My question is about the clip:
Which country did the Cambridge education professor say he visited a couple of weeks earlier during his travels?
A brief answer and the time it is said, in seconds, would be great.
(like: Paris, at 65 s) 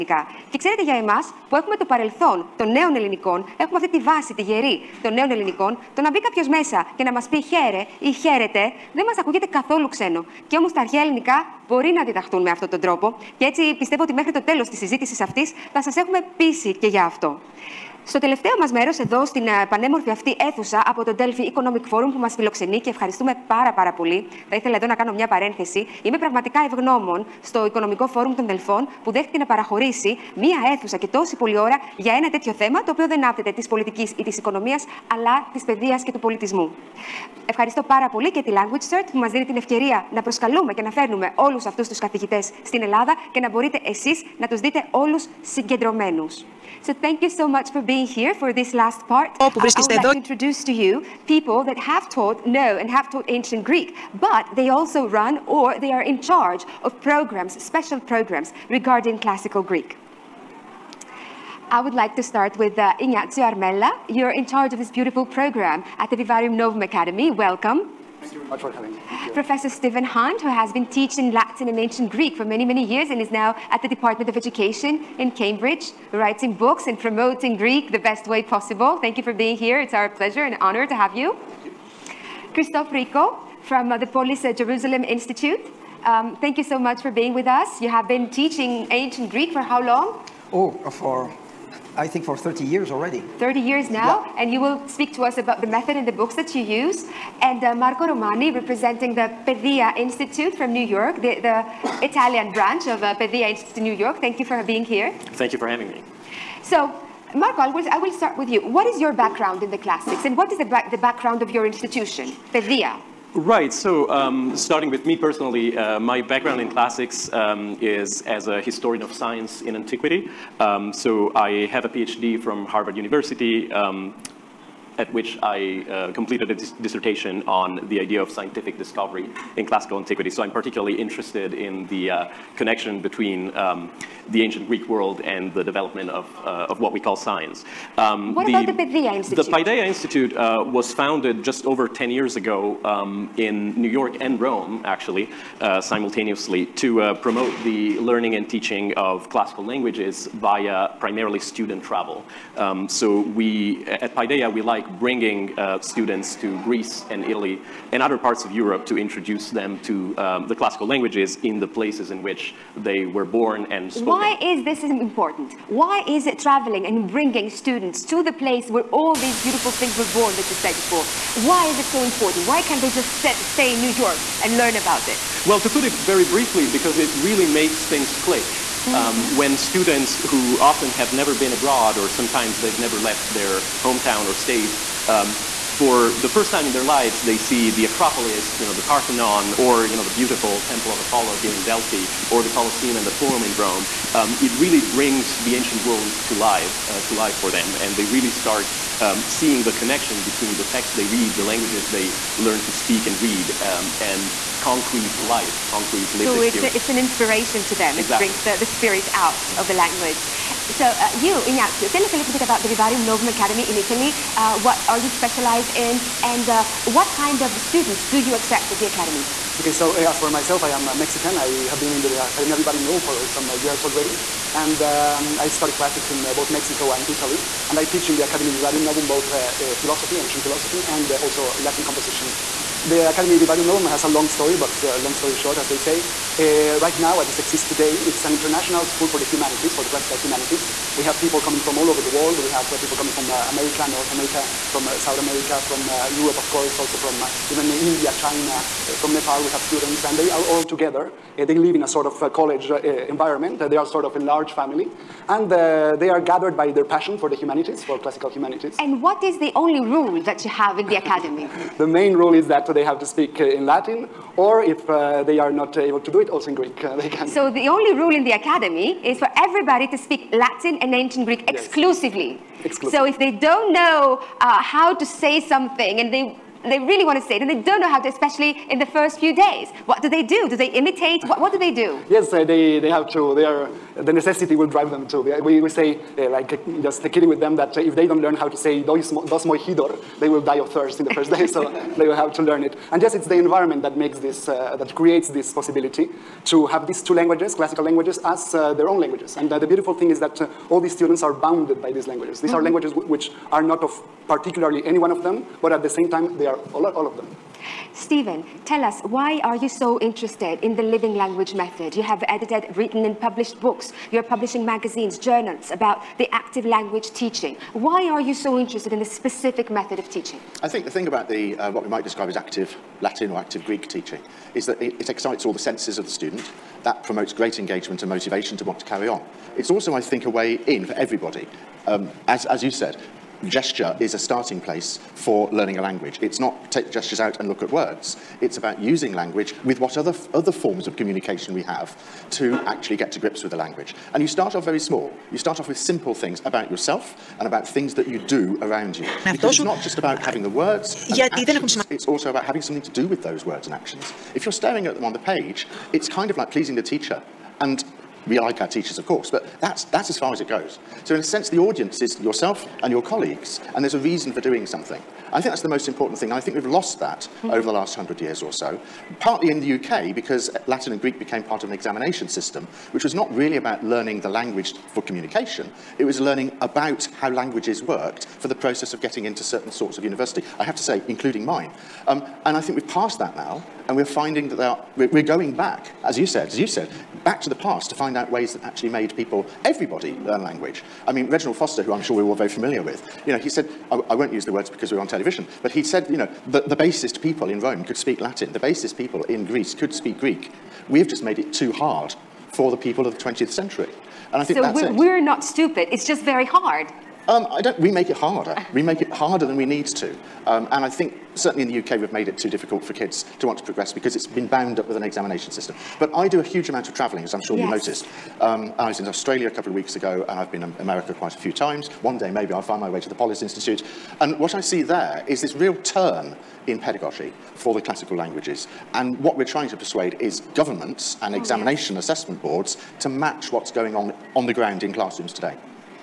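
Australia, at 419 s.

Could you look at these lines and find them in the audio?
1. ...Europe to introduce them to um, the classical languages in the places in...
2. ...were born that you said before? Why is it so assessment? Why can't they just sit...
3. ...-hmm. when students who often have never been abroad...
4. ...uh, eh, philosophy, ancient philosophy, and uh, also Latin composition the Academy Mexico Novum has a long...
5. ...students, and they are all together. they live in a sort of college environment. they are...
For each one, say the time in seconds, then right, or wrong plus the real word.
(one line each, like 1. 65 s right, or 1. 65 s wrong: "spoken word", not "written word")
1. 158 s right
2. 169 s wrong: "important", not "assessment"
3. 178 s right
4. 229 s wrong: "Vivarium", not "Mexico"
5. 249 s right.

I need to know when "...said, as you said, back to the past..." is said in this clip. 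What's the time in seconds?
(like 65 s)
386 s.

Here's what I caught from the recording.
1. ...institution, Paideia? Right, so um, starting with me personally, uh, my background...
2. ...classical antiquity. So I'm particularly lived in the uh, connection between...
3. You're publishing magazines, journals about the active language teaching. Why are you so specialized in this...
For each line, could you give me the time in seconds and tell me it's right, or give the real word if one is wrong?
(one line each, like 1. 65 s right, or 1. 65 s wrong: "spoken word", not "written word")
1. 111 s right
2. 129 s wrong: "interested", not "lived"
3. 314 s wrong: "interested", not "specialized".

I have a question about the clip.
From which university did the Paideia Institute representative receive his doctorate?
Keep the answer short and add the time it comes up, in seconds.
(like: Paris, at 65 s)
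Harvard University, at 122 s.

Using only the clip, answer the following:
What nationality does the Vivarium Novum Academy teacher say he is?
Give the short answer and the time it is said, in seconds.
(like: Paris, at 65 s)
Mexican, at 220 s.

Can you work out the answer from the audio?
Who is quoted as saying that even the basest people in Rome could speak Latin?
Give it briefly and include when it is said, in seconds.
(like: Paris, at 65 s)
Reginald Foster, at 391 s.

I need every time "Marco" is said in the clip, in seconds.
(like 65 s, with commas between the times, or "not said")
97 s, 107 s.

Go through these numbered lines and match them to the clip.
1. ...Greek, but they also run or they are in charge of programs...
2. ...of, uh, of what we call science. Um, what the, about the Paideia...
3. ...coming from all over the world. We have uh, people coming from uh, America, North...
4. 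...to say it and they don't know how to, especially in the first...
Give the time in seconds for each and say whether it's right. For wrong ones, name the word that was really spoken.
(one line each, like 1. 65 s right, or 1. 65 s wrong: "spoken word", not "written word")
1. 53 s right
2. 136 s right
3. 241 s right
4. 277 s right.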